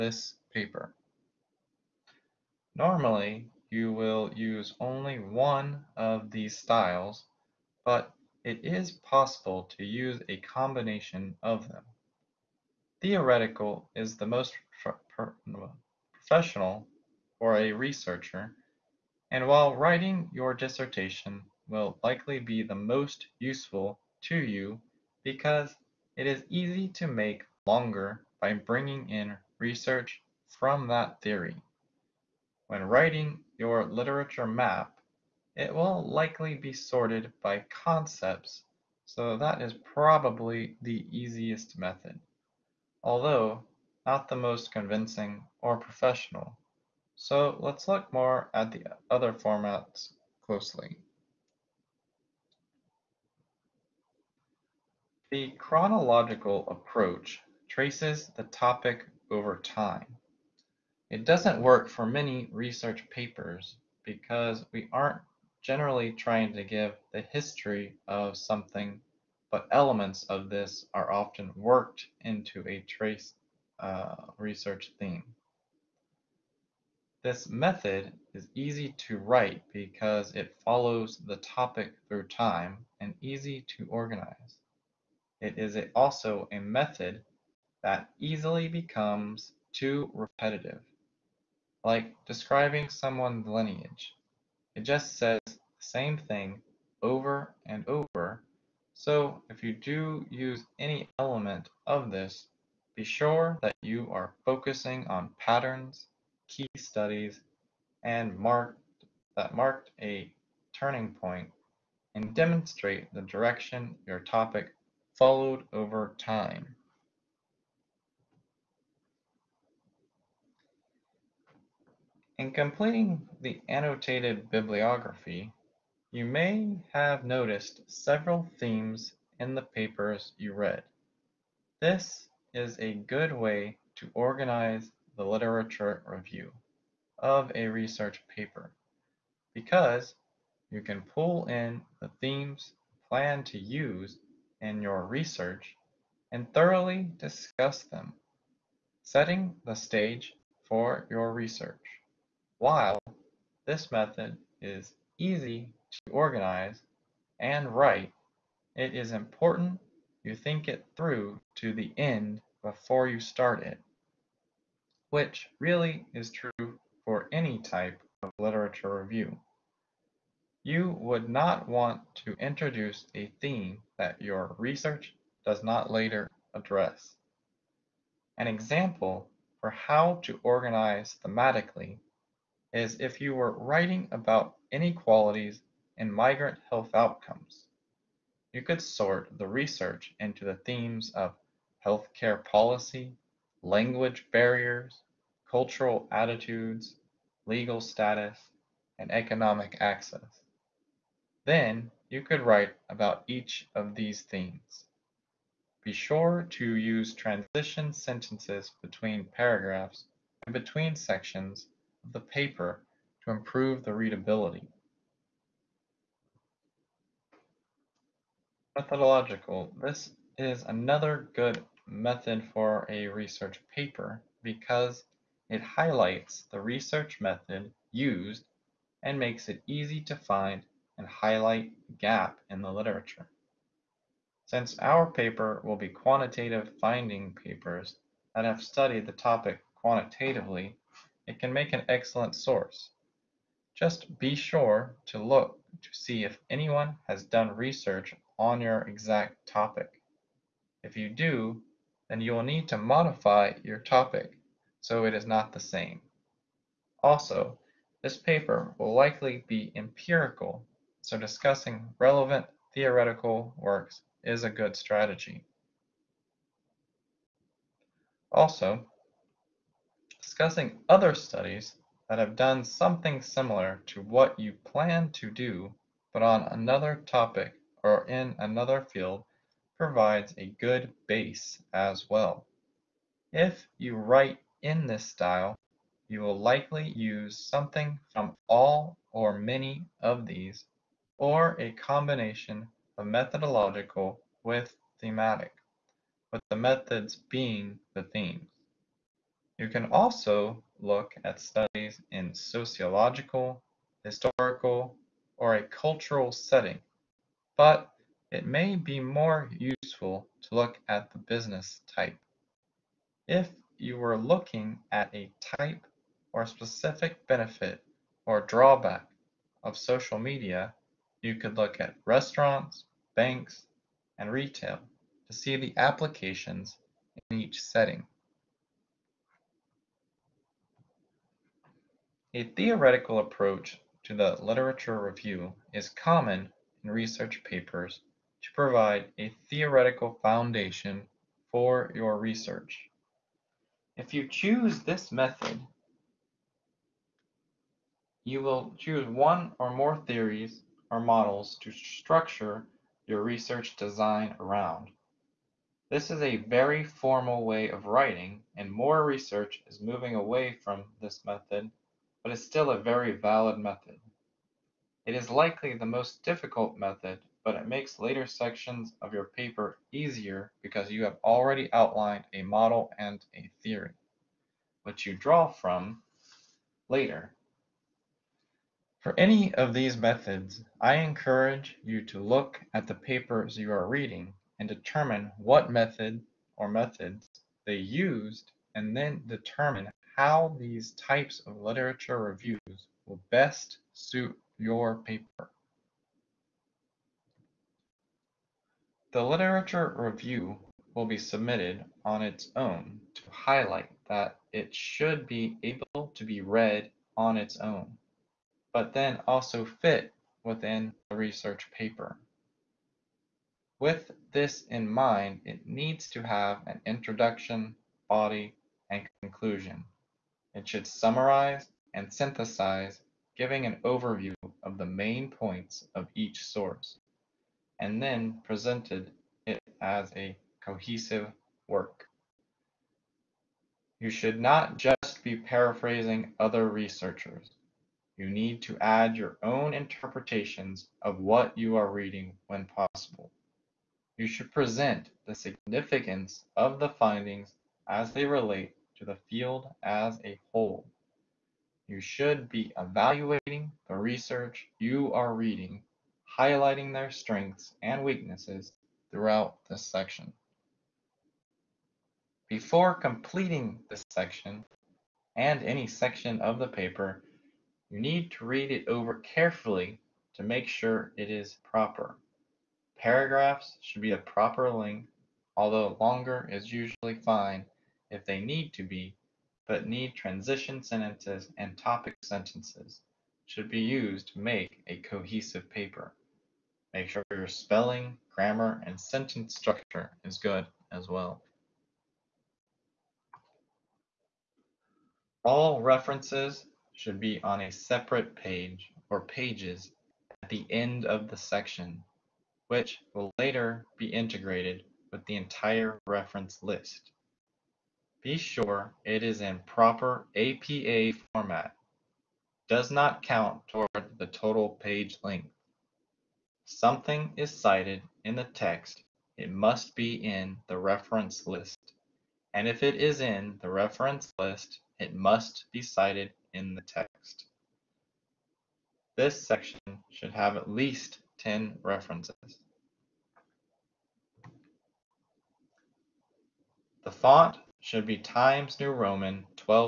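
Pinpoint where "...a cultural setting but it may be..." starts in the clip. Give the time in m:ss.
5:05.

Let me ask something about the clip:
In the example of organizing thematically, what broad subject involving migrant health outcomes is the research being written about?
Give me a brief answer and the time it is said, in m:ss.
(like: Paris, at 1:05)
inequalities, at 3:04.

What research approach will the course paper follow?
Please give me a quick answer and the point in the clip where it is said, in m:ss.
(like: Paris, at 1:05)
quantitative, at 3:55.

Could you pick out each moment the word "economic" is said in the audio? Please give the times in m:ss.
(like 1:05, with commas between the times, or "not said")
3:19.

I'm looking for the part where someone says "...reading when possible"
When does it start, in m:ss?
7:21.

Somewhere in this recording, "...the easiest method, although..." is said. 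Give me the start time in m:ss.
0:40.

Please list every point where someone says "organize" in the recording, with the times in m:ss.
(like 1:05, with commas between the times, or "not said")
1:23, 2:14, 2:36, 3:00.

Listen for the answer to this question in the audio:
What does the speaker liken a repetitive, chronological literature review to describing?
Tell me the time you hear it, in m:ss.
1:32.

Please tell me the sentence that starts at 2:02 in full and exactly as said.
In completing the annotated bibliography, you may have noticed several themes in the papers you read.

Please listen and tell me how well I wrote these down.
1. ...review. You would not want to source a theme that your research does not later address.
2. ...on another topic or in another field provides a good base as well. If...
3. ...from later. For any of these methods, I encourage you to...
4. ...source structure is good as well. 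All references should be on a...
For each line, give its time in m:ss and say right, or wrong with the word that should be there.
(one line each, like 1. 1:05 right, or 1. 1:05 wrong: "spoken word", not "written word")
1. 2:49 wrong: "introduce", not "source"
2. 4:36 right
3. 6:15 right
4. 8:08 wrong: "sentence", not "source".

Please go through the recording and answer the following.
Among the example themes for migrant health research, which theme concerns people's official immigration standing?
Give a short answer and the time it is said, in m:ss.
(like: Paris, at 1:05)
legal status, at 3:17.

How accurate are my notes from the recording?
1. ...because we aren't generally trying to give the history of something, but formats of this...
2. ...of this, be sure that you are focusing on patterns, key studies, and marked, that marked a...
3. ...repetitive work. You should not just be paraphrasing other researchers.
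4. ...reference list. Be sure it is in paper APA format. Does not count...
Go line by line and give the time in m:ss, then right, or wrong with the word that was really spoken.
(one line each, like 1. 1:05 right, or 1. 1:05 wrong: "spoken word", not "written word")
1. 1:04 wrong: "elements", not "formats"
2. 1:41 right
3. 7:10 wrong: "cohesive", not "repetitive"
4. 8:26 wrong: "proper", not "paper".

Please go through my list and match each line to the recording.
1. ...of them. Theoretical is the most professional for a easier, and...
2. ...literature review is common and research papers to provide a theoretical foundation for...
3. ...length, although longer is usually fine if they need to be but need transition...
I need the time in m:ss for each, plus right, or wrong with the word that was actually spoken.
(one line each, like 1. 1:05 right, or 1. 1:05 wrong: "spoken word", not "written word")
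1. 0:11 wrong: "researcher", not "easier"
2. 5:34 right
3. 7:54 right.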